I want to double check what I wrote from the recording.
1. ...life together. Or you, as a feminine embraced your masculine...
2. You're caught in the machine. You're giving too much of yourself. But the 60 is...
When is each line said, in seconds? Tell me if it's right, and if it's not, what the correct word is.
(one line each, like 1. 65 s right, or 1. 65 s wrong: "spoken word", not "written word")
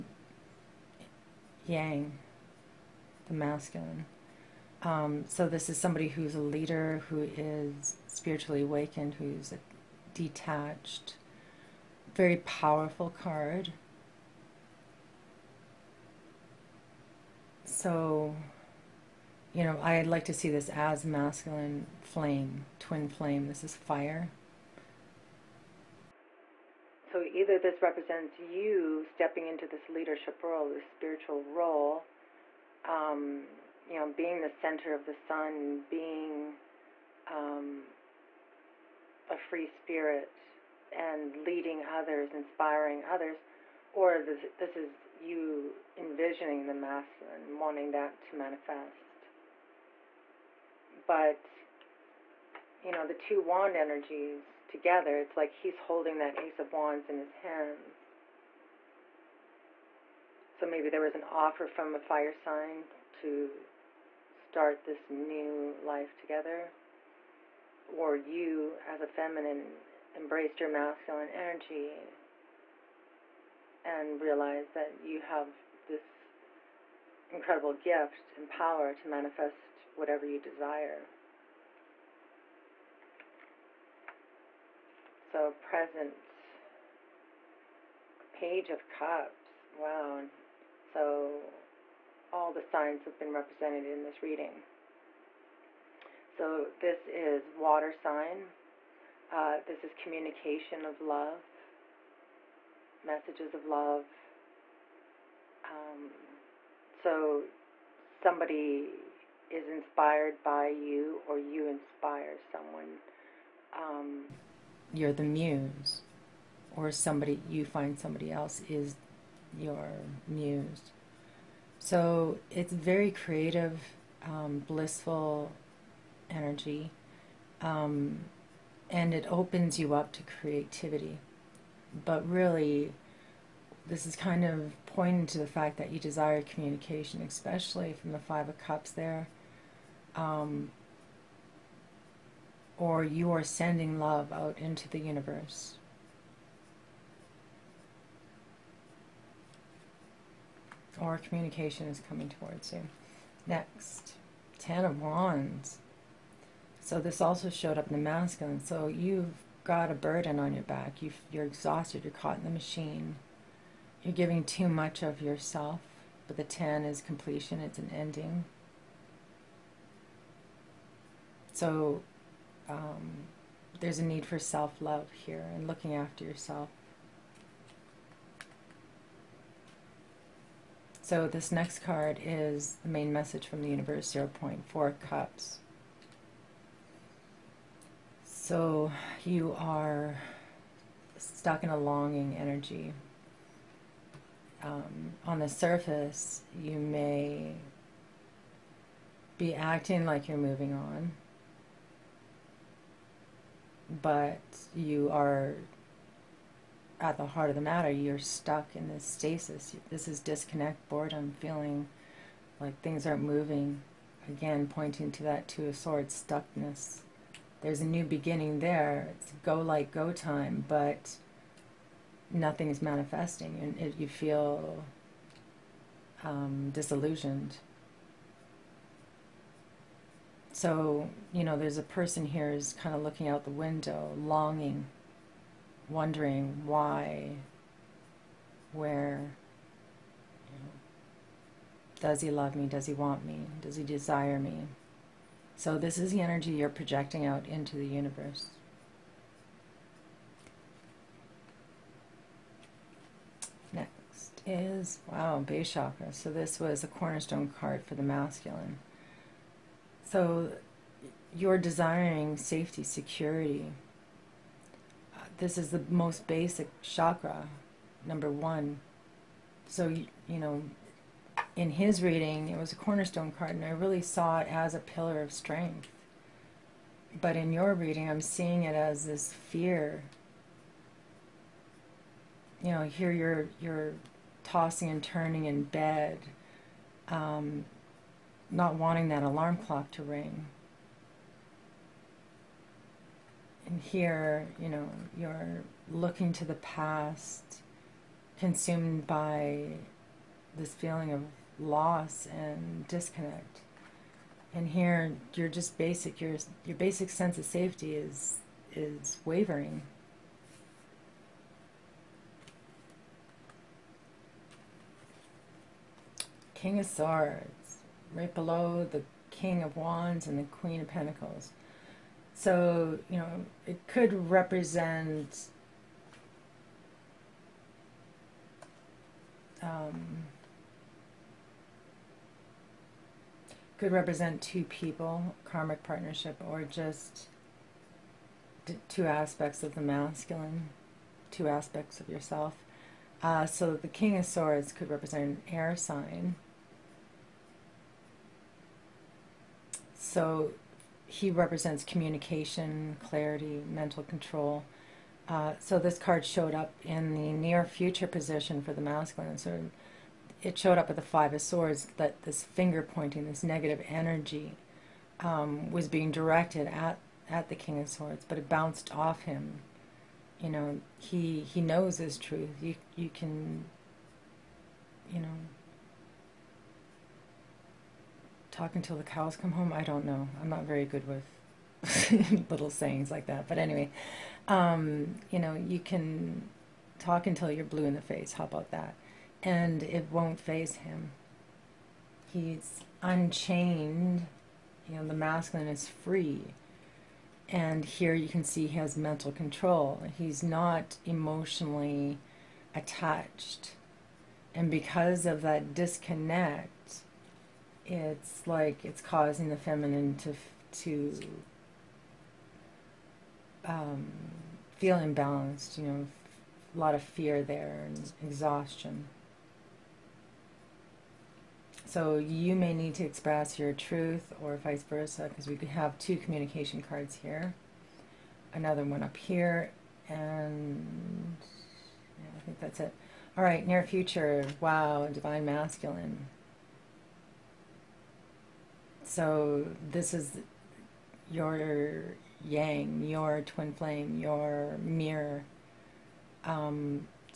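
1. 65 s right
2. 162 s wrong: "10", not "60".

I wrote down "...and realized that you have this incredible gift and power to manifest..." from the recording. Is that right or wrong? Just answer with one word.
right.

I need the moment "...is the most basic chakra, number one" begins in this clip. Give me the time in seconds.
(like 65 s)
265 s.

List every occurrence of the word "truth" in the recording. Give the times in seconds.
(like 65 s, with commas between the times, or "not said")
372 s, 423 s.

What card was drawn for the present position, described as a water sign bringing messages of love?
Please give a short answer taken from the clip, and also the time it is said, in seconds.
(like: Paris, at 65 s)
Page of Cups, at 88 s.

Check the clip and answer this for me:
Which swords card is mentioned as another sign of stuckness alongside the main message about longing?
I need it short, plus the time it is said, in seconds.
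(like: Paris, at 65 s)
Two of Swords, at 215 s.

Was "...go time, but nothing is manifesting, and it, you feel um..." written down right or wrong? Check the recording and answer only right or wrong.
right.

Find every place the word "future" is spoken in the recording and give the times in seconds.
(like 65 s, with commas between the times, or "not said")
357 s, 433 s.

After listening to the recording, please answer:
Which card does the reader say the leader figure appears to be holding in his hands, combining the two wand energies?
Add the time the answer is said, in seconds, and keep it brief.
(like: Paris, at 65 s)
Ace of Wands, at 56 s.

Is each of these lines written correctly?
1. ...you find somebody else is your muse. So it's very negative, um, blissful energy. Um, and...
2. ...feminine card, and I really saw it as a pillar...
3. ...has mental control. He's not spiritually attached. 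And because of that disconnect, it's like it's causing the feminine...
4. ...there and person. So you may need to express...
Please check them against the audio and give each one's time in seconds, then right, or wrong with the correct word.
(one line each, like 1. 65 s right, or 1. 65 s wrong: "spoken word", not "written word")
1. 117 s wrong: "creative", not "negative"
2. 272 s wrong: "cornerstone", not "feminine"
3. 398 s wrong: "emotionally", not "spiritually"
4. 417 s wrong: "exhaustion", not "person".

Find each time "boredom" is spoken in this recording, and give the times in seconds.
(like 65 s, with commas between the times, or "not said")
210 s.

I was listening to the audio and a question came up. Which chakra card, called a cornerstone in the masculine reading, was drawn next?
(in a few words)
Base chakra.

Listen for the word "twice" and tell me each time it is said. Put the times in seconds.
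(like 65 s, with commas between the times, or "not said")
not said.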